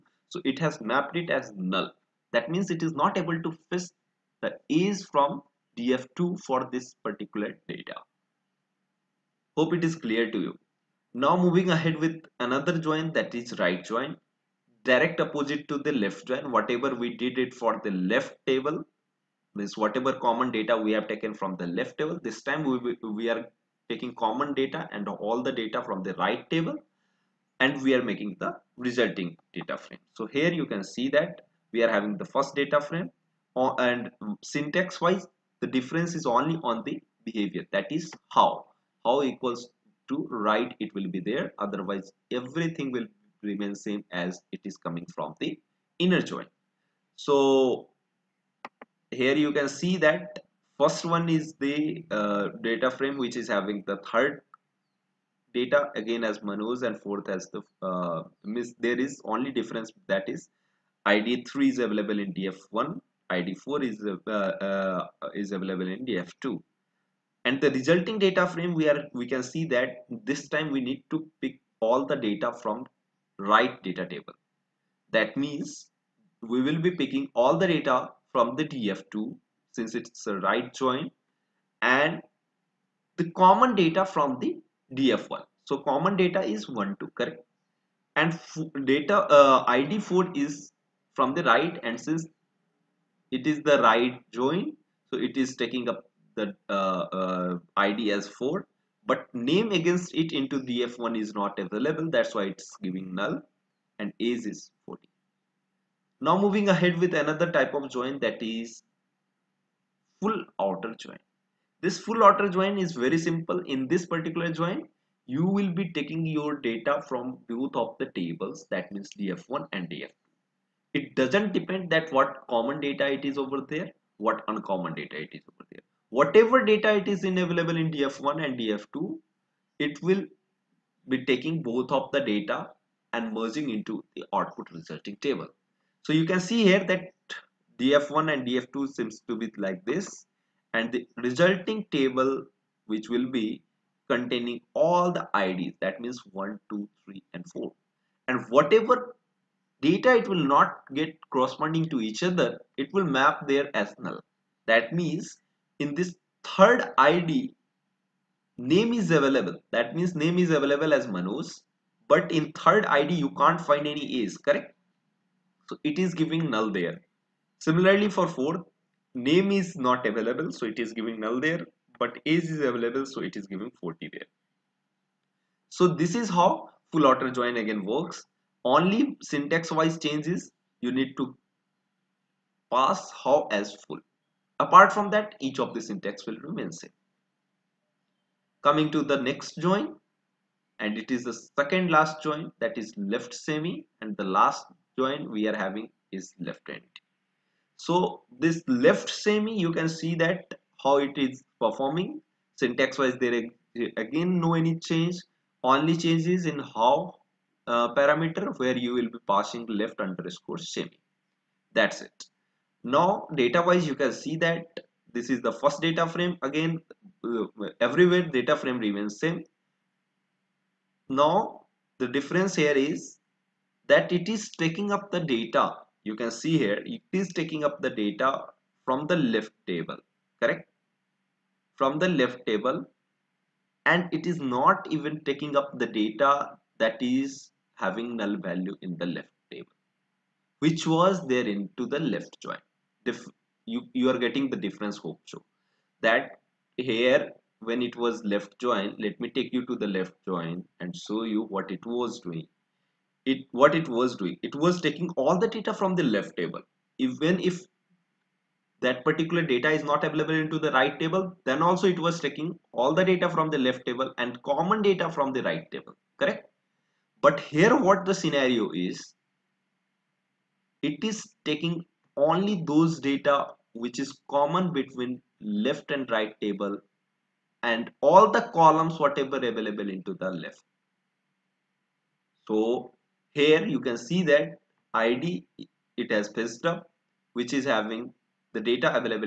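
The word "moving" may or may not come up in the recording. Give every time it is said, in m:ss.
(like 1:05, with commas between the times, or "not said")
0:11, 1:46.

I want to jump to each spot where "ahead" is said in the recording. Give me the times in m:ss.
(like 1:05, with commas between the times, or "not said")
0:11, 1:46.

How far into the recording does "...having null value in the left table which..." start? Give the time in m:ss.
3:57.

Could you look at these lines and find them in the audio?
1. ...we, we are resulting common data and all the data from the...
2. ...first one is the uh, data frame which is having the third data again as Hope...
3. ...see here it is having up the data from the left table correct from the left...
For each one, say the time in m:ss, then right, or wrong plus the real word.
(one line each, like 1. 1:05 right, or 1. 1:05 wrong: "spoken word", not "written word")
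1. 0:22 wrong: "taking", not "resulting"
2. 0:50 wrong: "Manoj", not "Hope"
3. 3:46 wrong: "taking", not "having".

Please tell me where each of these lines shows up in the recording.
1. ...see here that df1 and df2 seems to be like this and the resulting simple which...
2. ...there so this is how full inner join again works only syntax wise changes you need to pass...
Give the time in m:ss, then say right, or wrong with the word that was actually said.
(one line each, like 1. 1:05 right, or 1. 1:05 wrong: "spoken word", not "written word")
1. 2:16 wrong: "table", not "simple"
2. 2:54 wrong: "outer", not "inner".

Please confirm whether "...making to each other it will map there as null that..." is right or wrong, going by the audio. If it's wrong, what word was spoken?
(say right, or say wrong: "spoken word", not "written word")
wrong: "corresponding", not "making".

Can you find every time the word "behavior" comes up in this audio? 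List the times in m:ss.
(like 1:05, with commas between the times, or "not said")
0:37.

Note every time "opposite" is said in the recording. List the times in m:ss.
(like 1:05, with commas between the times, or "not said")
0:15.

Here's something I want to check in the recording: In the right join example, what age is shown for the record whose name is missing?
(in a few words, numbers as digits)
40.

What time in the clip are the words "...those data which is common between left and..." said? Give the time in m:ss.
4:32.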